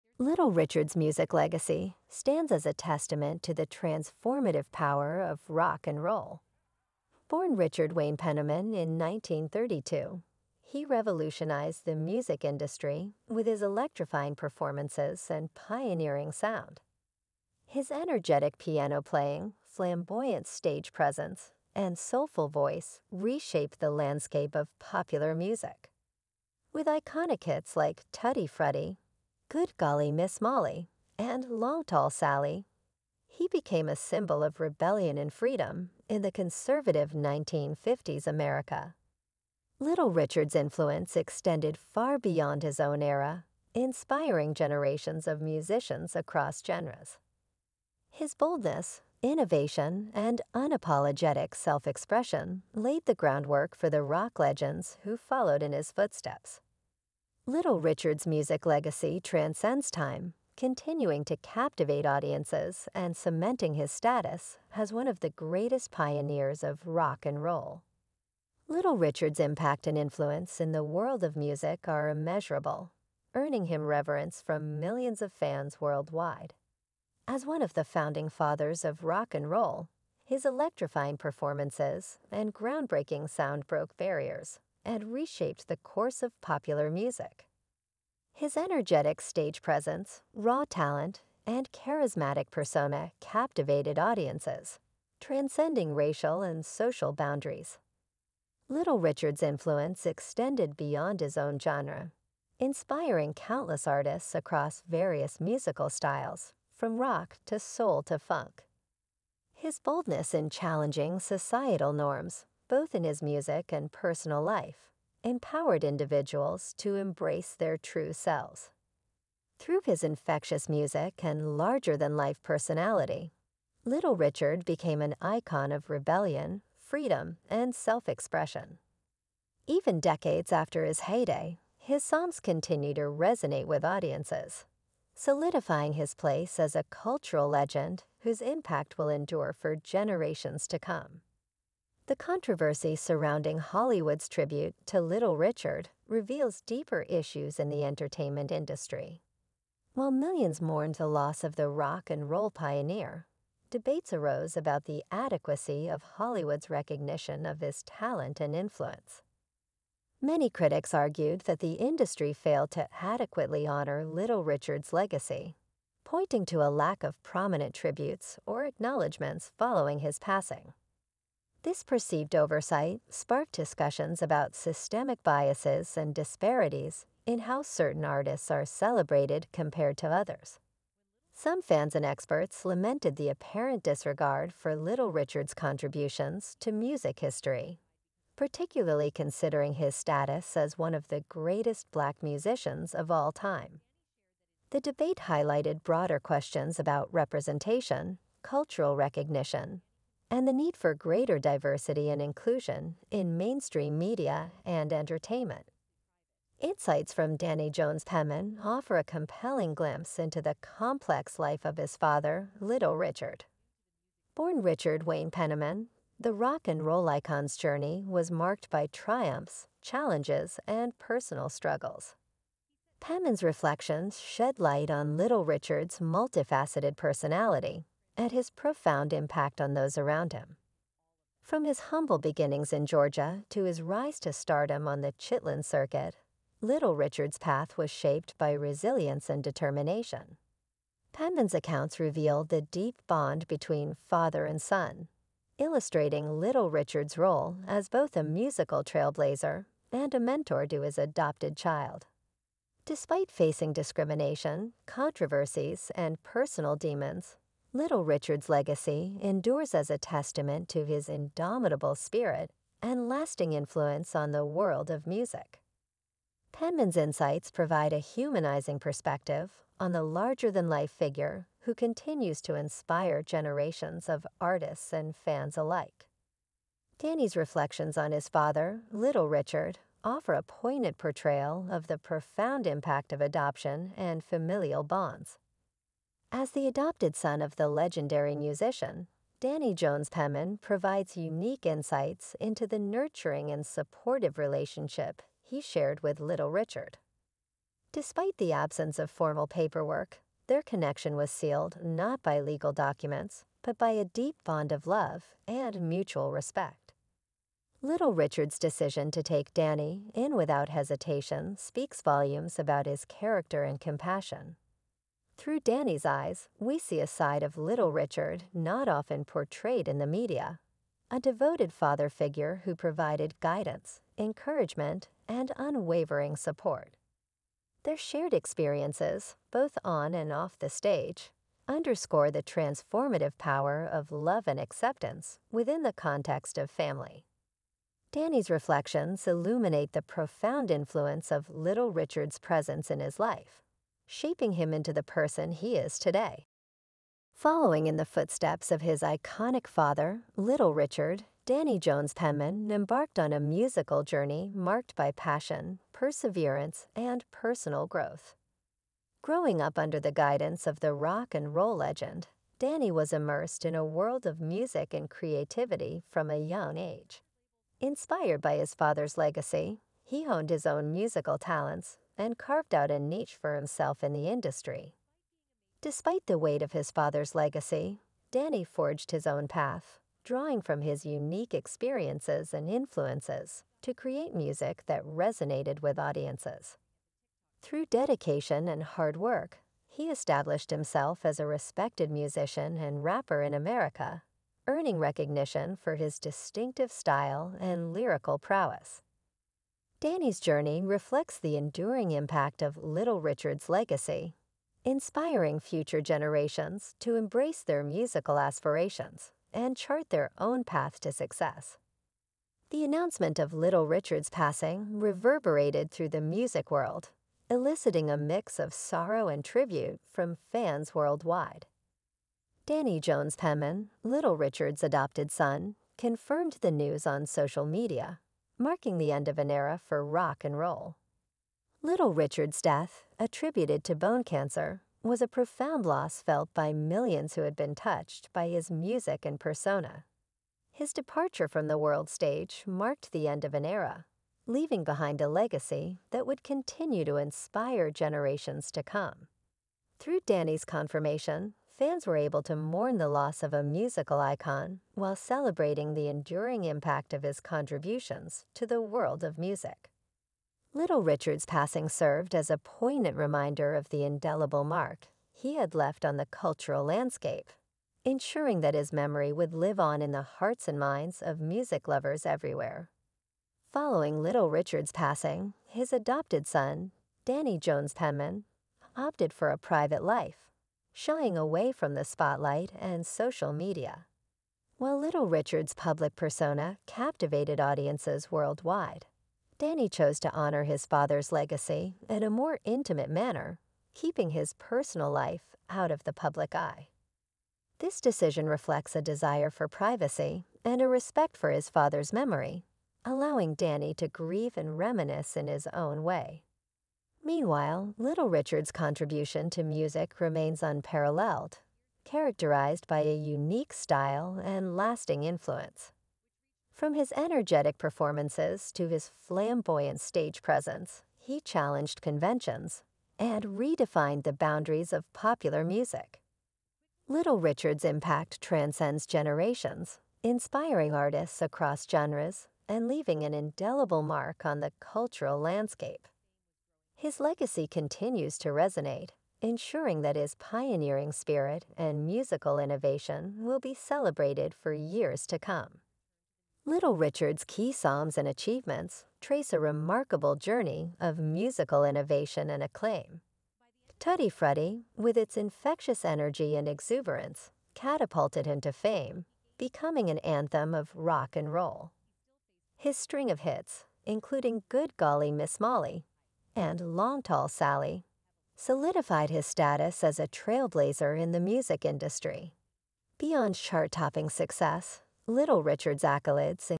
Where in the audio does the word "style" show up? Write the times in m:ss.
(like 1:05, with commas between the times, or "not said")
1:45, 6:36, 8:33.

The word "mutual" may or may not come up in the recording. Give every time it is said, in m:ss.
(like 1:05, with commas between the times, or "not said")
5:05.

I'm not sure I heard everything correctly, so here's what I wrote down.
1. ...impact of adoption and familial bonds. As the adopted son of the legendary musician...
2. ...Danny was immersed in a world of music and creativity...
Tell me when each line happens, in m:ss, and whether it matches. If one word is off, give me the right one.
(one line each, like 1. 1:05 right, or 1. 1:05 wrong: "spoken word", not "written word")
1. 4:42 right
2. 6:02 right.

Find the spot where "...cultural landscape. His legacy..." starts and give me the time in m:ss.
8:54.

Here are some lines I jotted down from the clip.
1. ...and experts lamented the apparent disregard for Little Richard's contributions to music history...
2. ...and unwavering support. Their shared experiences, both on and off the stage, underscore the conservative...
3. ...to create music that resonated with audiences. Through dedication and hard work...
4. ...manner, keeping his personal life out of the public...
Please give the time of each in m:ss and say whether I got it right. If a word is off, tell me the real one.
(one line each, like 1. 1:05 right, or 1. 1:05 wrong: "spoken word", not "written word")
1. 3:01 right
2. 5:25 wrong: "transformative", not "conservative"
3. 6:23 right
4. 8:13 right.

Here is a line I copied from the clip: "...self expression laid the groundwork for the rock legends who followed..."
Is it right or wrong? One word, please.
right.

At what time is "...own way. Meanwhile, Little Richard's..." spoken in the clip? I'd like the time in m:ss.
8:25.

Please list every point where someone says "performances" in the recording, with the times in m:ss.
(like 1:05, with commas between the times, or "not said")
0:14, 1:21, 8:37.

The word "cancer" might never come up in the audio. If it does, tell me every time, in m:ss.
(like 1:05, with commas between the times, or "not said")
7:14.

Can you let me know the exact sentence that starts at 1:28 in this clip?
His energetic stage presence, raw talent, and charismatic persona captivated audiences, transcending racial and social boundaries.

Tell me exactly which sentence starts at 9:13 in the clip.
Tutti Frutti, with its infectious energy and exuberance, catapulted him to fame, becoming an anthem of rock and roll.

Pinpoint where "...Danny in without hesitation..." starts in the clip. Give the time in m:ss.
5:09.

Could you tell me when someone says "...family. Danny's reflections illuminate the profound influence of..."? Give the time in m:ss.
5:36.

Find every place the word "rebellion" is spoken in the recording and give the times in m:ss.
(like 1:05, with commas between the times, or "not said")
0:34, 2:05.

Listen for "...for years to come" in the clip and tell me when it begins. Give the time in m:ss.
9:04.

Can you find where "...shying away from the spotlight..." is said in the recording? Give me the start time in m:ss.
8:00.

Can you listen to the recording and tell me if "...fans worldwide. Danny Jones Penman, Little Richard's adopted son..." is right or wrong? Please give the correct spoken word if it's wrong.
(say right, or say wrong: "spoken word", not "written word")
right.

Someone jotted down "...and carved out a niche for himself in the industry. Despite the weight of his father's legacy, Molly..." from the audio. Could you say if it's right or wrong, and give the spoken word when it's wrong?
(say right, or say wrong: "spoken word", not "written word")
wrong: "Danny", not "Molly".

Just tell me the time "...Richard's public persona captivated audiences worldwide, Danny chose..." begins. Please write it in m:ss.
8:05.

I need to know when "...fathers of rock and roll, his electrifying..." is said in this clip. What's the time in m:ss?
1:18.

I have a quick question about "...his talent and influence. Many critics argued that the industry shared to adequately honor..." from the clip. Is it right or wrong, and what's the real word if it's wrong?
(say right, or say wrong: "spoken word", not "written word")
wrong: "failed", not "shared".